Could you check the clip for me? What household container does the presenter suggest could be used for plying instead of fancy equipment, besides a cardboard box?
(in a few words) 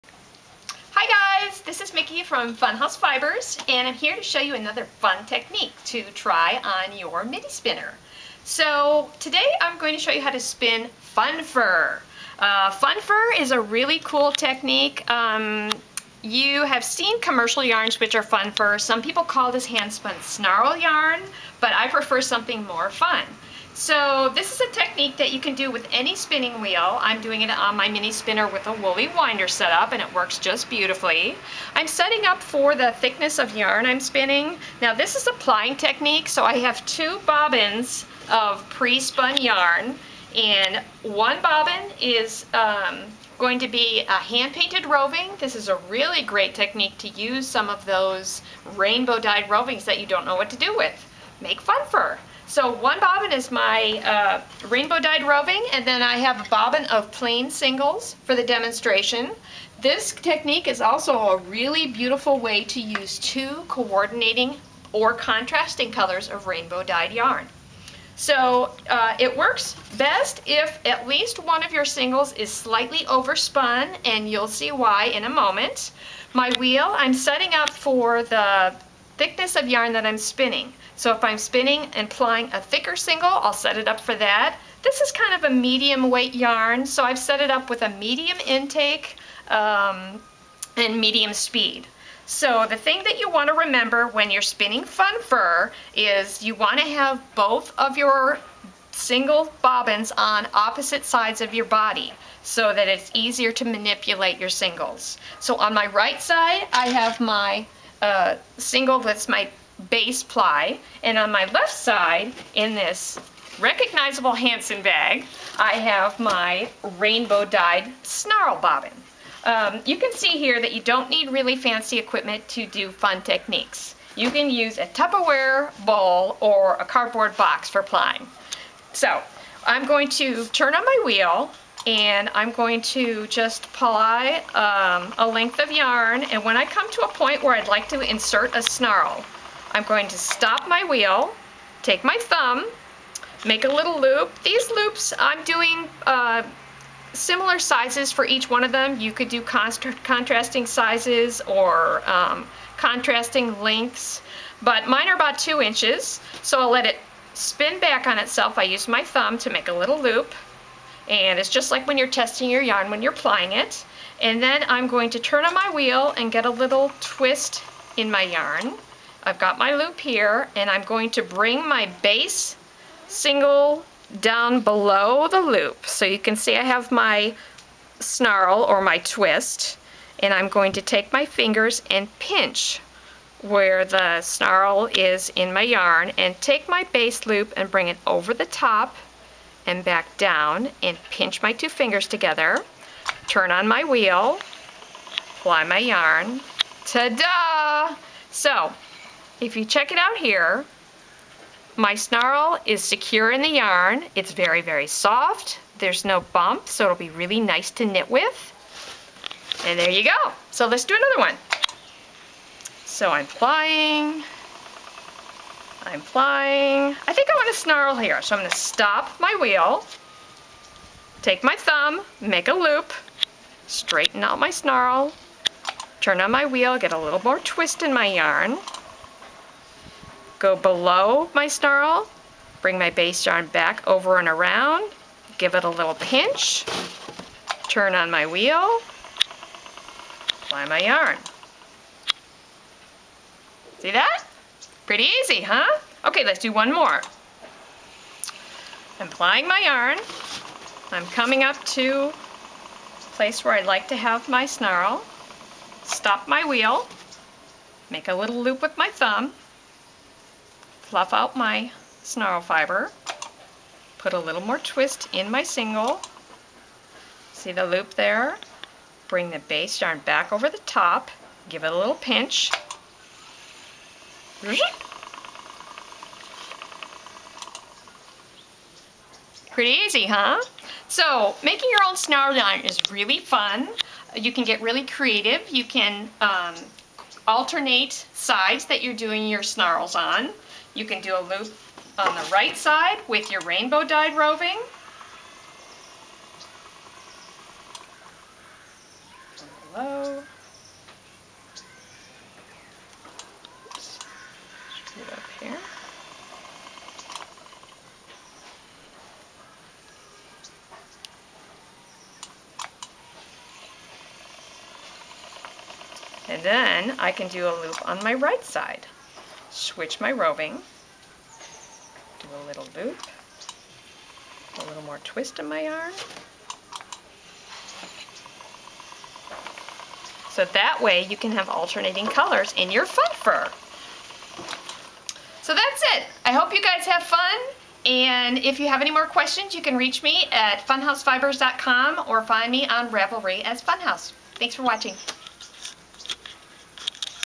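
Tupperware bowl.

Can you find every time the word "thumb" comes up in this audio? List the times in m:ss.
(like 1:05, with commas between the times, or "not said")
2:22, 2:39, 3:41, 4:18.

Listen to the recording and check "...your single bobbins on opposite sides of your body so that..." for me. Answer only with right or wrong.
right.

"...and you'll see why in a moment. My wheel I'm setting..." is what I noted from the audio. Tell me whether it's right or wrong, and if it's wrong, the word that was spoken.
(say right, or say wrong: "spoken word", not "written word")
right.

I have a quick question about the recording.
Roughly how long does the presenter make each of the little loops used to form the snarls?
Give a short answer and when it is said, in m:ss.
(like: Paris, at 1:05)
2 inches, at 2:35.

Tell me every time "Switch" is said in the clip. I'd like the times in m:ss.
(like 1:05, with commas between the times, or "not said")
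5:19.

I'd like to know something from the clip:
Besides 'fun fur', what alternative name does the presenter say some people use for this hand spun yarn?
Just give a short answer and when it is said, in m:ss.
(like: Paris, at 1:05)
snarl yarn, at 0:20.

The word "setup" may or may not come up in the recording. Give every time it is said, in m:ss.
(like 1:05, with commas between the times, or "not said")
0:29.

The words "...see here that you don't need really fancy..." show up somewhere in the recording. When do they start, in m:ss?
2:00.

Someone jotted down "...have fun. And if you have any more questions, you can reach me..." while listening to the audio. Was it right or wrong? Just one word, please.
right.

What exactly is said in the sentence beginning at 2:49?
I've got my loop here and I'm going to bring my base single down below the loop.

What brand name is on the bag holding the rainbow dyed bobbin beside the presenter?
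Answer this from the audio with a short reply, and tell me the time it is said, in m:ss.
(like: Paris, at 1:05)
Hansen, at 1:54.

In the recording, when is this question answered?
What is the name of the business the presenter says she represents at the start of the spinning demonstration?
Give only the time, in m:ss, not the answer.
0:02.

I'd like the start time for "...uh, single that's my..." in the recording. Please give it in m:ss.
1:48.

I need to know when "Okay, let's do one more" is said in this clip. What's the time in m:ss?
4:06.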